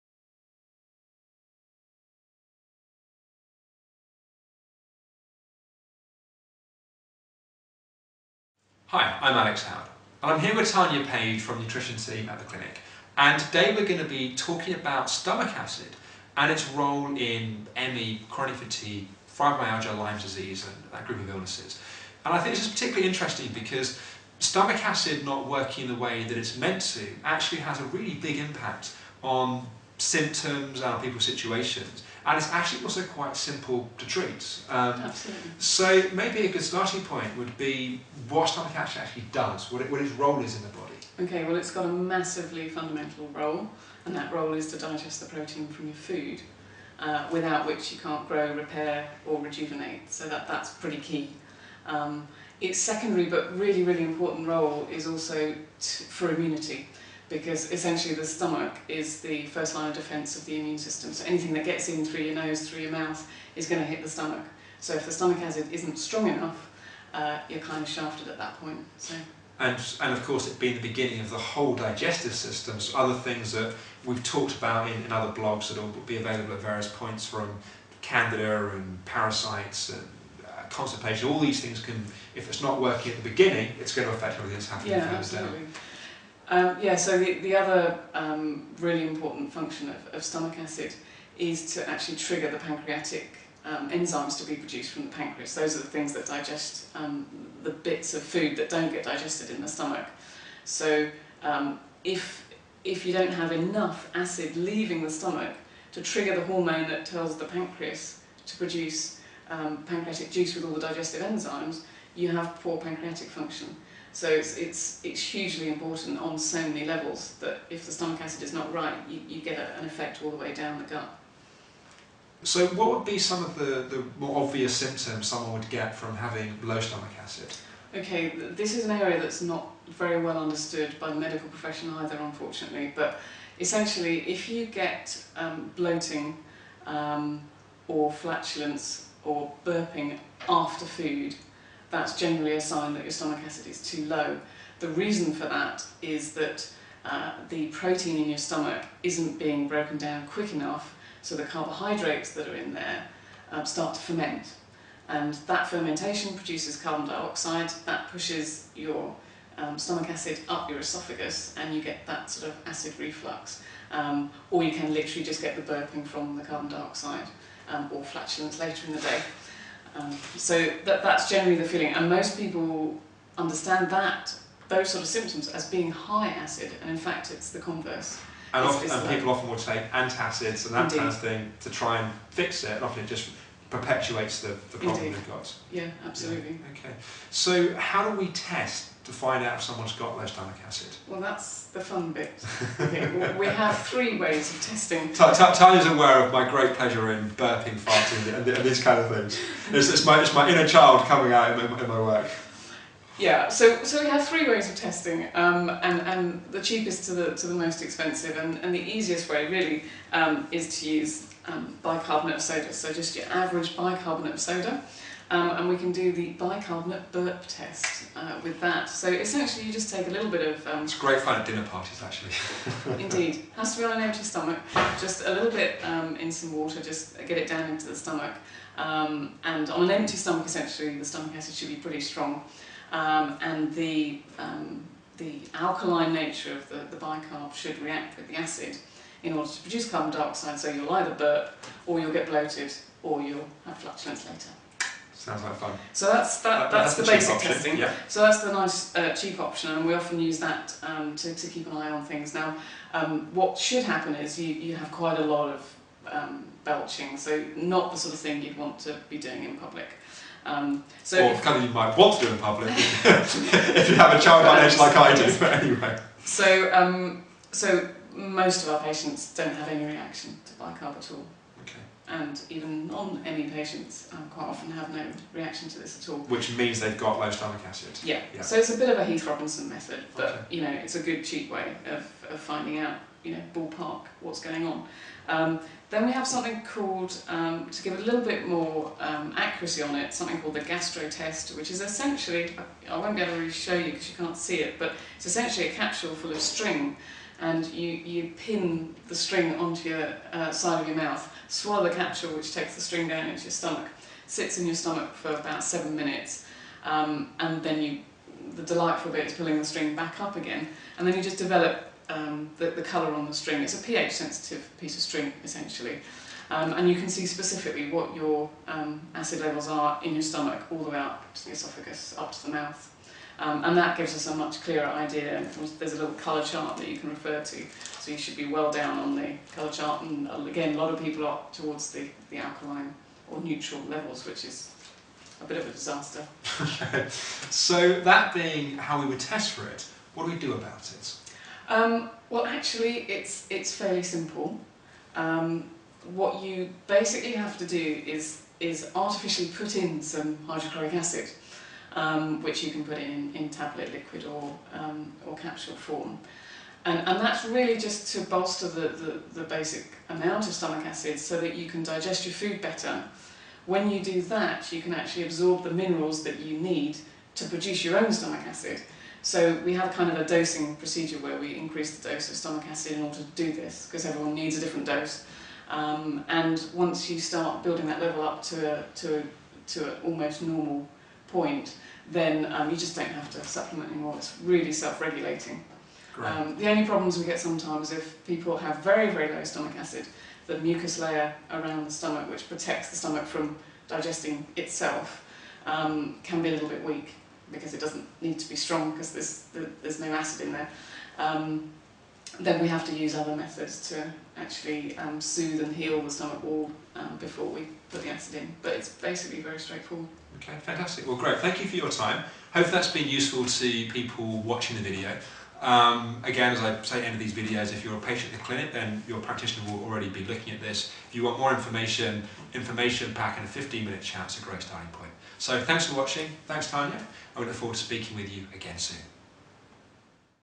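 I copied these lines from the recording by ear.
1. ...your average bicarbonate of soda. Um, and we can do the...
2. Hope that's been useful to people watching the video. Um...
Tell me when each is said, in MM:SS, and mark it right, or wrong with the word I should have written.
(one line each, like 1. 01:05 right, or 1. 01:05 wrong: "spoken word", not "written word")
1. 03:33 right
2. 06:52 right.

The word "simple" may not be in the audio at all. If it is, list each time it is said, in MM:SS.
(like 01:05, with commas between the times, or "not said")
00:33, 05:44.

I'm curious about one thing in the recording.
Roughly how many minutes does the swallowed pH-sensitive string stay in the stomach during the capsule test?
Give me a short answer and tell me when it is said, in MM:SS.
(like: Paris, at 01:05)
7, at 05:05.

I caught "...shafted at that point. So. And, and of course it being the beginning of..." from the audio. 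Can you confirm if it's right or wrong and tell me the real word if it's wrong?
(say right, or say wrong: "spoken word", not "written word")
right.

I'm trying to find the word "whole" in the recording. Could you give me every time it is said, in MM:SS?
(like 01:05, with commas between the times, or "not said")
01:11.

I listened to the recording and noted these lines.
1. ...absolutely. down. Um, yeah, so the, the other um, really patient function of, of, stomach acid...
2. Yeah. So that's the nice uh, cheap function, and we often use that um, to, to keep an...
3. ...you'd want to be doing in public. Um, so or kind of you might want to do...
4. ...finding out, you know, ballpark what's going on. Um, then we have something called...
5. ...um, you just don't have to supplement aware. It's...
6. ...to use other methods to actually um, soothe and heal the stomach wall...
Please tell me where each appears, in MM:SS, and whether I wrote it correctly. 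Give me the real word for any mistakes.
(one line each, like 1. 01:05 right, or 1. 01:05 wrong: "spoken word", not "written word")
1. 01:25 wrong: "important", not "patient"
2. 04:07 wrong: "option", not "function"
3. 04:18 right
4. 04:42 right
5. 06:22 wrong: "anymore", not "aware"
6. 06:42 right.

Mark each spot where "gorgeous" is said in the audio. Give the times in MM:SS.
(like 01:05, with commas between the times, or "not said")
not said.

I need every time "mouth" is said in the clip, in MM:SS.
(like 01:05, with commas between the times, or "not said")
01:02, 05:00, 05:22.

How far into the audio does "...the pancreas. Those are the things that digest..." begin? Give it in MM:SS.
01:35.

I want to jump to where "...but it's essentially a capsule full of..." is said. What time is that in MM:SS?
04:54.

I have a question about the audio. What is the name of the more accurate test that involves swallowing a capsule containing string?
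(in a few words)
gastro test.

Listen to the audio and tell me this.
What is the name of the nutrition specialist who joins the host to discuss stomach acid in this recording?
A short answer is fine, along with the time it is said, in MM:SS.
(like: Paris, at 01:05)
Tanya Page, at 00:10.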